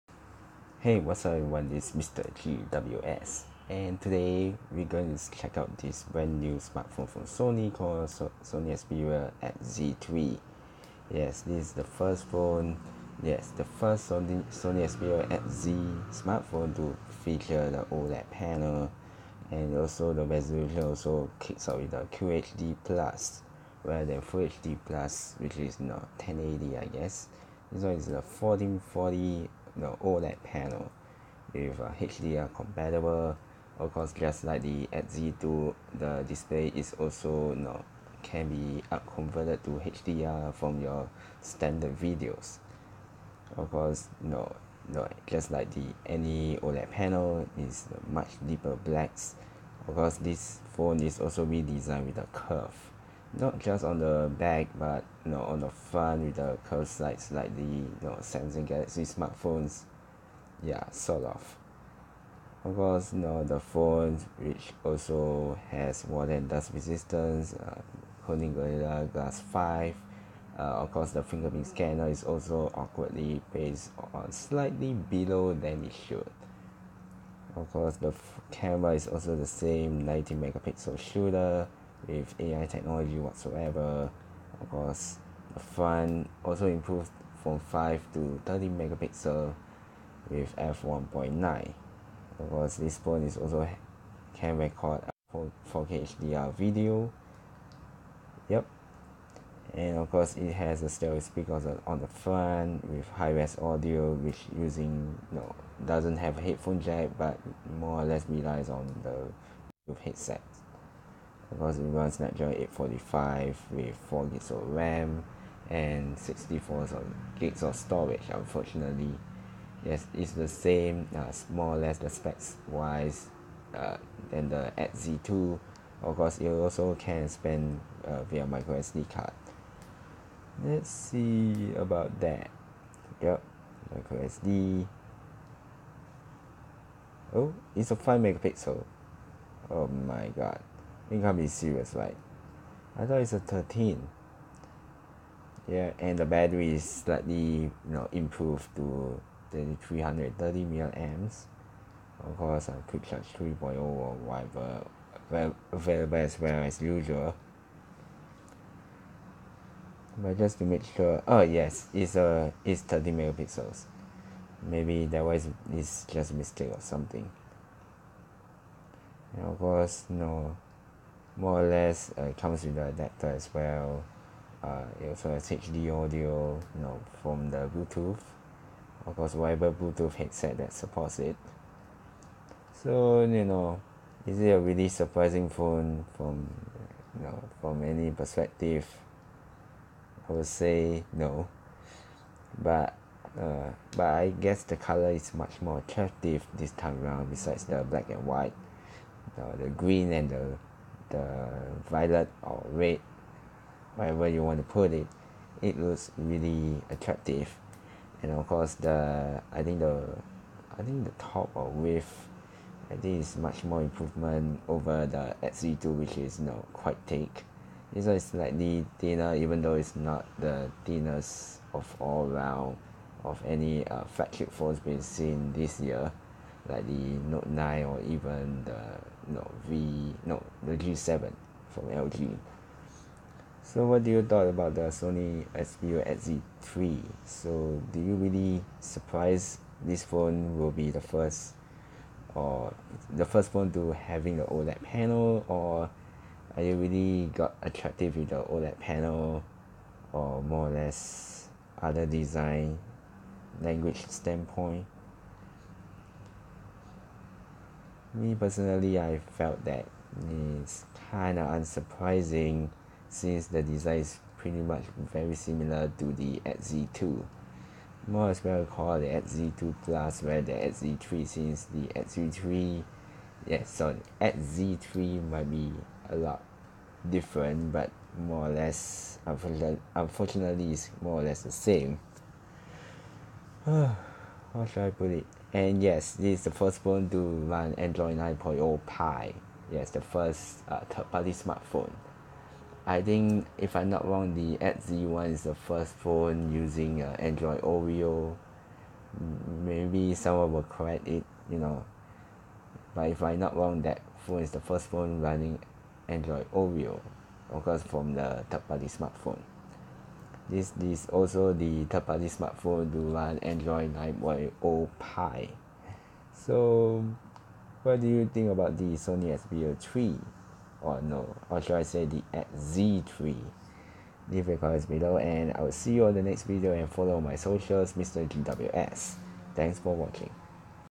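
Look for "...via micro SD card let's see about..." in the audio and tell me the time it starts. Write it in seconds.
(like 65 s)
128 s.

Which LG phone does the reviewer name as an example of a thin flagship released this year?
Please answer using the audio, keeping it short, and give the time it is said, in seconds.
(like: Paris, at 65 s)
G7, at 230 s.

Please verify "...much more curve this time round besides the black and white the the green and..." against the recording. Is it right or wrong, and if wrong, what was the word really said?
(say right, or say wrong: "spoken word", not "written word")
wrong: "attractive", not "curve".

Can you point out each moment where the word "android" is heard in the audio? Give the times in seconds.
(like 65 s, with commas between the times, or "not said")
287 s, 297 s, 306 s, 313 s.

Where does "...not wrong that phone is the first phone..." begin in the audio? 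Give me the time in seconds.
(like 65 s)
303 s.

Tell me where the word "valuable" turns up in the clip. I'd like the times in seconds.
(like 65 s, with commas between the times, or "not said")
not said.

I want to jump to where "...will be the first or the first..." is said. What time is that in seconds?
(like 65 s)
240 s.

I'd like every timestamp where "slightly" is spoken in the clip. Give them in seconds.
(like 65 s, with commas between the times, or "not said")
74 s, 146 s, 218 s.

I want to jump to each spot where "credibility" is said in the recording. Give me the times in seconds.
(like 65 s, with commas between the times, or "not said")
not said.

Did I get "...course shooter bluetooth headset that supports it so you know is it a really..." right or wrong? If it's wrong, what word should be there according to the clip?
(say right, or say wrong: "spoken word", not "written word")
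wrong: "whatever", not "shooter".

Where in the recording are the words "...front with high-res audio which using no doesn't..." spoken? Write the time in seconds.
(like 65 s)
102 s.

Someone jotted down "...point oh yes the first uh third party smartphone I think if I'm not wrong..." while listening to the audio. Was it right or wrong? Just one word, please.
right.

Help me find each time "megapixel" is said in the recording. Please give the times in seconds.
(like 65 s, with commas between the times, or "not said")
80 s, 88 s, 138 s, 163 s.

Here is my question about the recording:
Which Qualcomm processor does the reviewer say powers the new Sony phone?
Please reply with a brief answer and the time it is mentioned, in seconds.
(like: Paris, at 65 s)
Snapdragon 845, at 112 s.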